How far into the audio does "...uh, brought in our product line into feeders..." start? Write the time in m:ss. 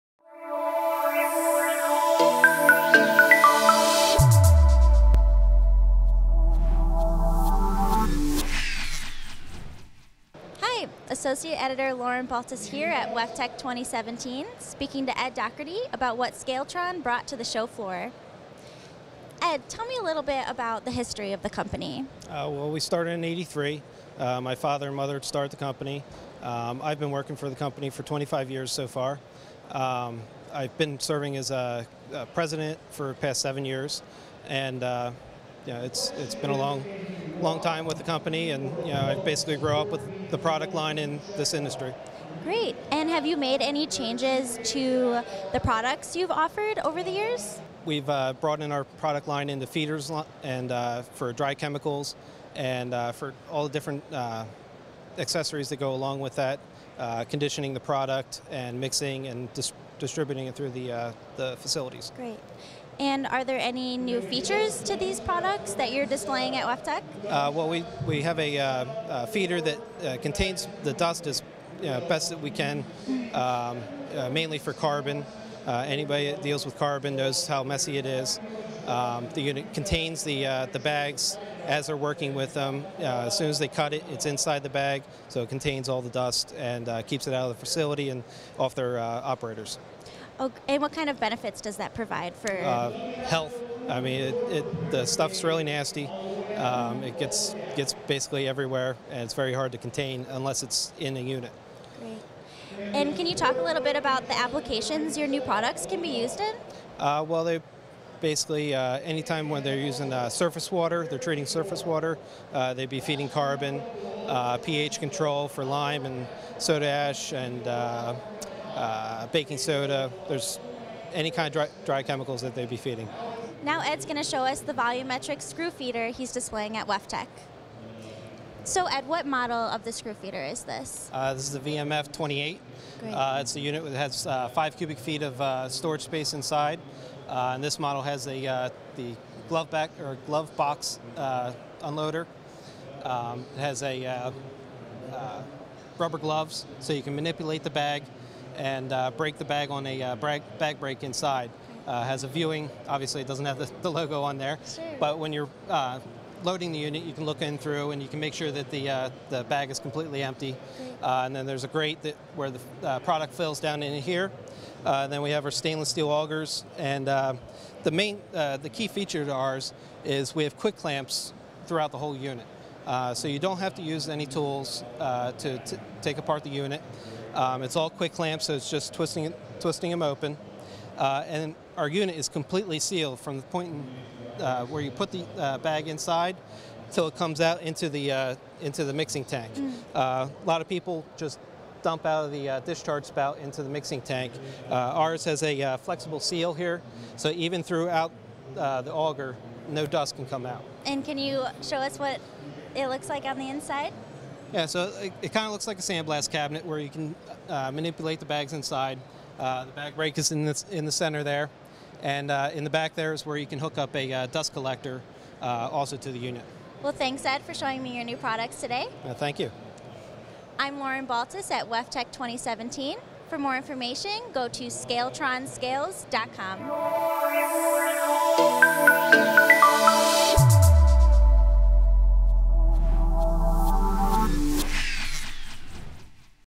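0:48.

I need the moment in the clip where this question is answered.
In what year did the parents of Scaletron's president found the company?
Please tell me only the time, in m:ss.
0:23.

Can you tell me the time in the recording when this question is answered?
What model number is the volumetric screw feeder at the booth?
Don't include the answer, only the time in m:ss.
2:11.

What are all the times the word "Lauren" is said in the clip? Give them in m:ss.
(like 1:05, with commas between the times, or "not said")
0:11, 3:40.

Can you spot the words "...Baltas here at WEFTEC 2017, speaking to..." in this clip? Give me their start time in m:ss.
0:12.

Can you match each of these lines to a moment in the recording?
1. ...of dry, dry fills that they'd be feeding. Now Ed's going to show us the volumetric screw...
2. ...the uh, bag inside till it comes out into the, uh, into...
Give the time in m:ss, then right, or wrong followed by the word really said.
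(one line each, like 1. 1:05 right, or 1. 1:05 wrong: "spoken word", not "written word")
1. 2:01 wrong: "chemicals", not "fills"
2. 3:05 right.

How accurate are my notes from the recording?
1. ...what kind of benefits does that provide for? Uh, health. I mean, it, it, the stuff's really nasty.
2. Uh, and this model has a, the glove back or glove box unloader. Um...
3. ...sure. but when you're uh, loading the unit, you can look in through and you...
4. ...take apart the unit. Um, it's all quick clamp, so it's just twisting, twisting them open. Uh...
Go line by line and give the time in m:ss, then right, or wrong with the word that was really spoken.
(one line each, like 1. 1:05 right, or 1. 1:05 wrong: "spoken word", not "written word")
1. 1:30 right
2. 2:17 right
3. 2:34 right
4. 2:56 right.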